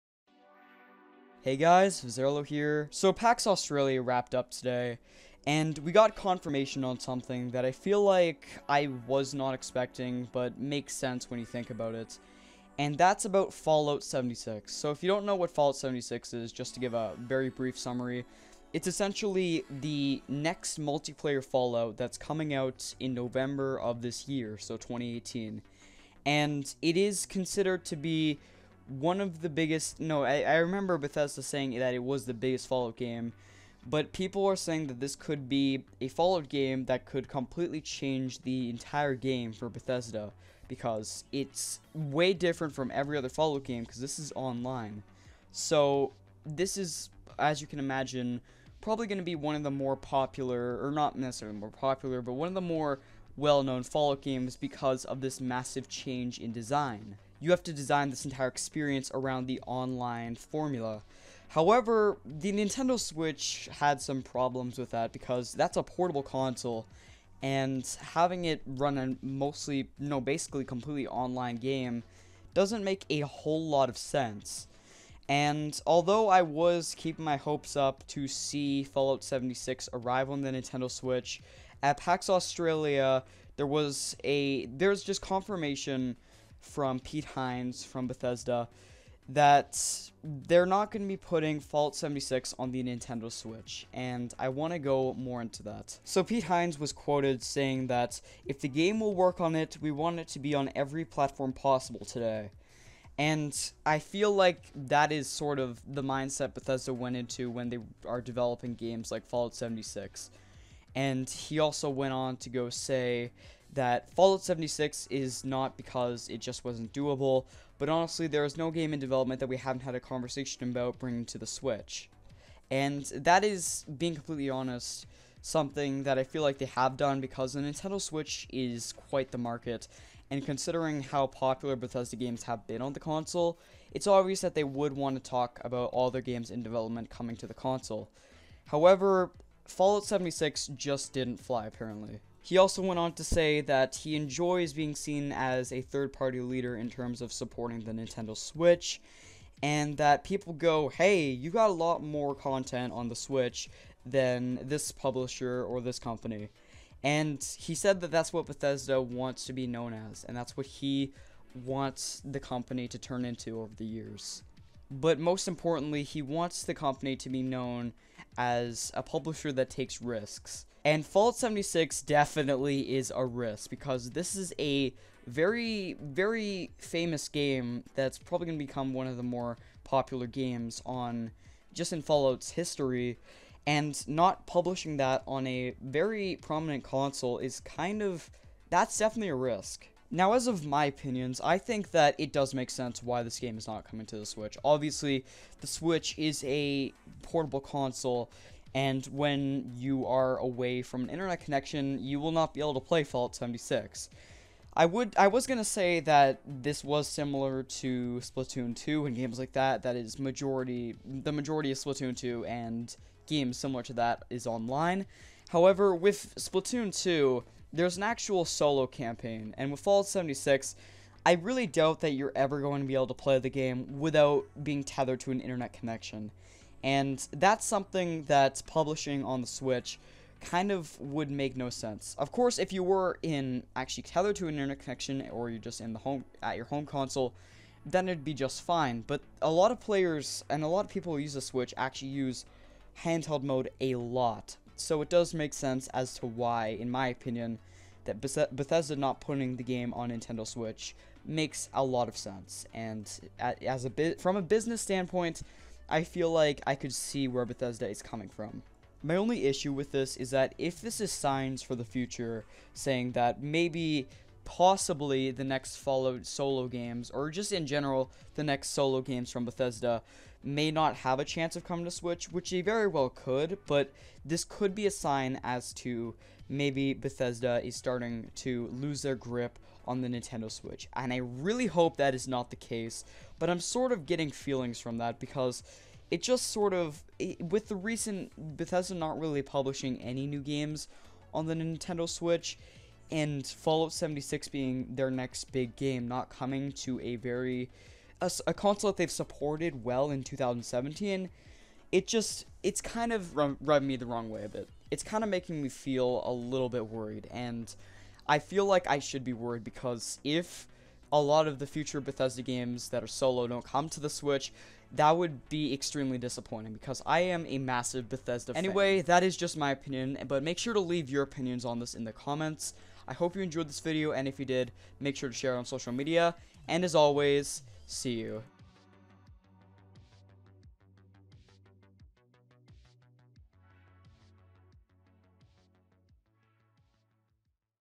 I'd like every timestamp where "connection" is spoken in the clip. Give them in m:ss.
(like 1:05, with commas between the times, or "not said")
3:21, 3:45, 3:54.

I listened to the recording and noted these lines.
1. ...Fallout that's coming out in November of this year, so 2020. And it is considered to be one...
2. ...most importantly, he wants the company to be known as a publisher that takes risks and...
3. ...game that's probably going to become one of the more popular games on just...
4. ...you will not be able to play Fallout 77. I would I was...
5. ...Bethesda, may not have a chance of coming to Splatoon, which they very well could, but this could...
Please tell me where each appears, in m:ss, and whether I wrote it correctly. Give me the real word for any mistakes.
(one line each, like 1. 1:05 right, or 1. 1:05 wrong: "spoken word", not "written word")
1. 0:21 wrong: "2018", not "2020"
2. 2:45 right
3. 2:57 right
4. 3:22 wrong: "76", not "77"
5. 4:29 wrong: "Switch", not "Splatoon".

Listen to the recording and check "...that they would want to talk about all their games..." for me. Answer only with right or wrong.
right.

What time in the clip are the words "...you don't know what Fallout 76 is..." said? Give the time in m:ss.
0:15.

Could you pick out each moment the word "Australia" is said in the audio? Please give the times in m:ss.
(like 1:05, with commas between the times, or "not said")
0:03, 1:22.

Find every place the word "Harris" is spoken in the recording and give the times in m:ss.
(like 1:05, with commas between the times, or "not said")
not said.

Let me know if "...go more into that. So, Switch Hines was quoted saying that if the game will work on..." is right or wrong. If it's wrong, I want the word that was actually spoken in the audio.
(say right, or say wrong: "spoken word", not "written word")
wrong: "Pete", not "Switch".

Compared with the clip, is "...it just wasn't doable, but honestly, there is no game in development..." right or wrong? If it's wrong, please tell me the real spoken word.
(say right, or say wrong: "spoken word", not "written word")
right.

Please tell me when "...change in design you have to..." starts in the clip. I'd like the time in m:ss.
0:55.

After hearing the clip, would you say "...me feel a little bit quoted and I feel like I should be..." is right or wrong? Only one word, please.
wrong.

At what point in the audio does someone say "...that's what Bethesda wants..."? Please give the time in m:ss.
2:38.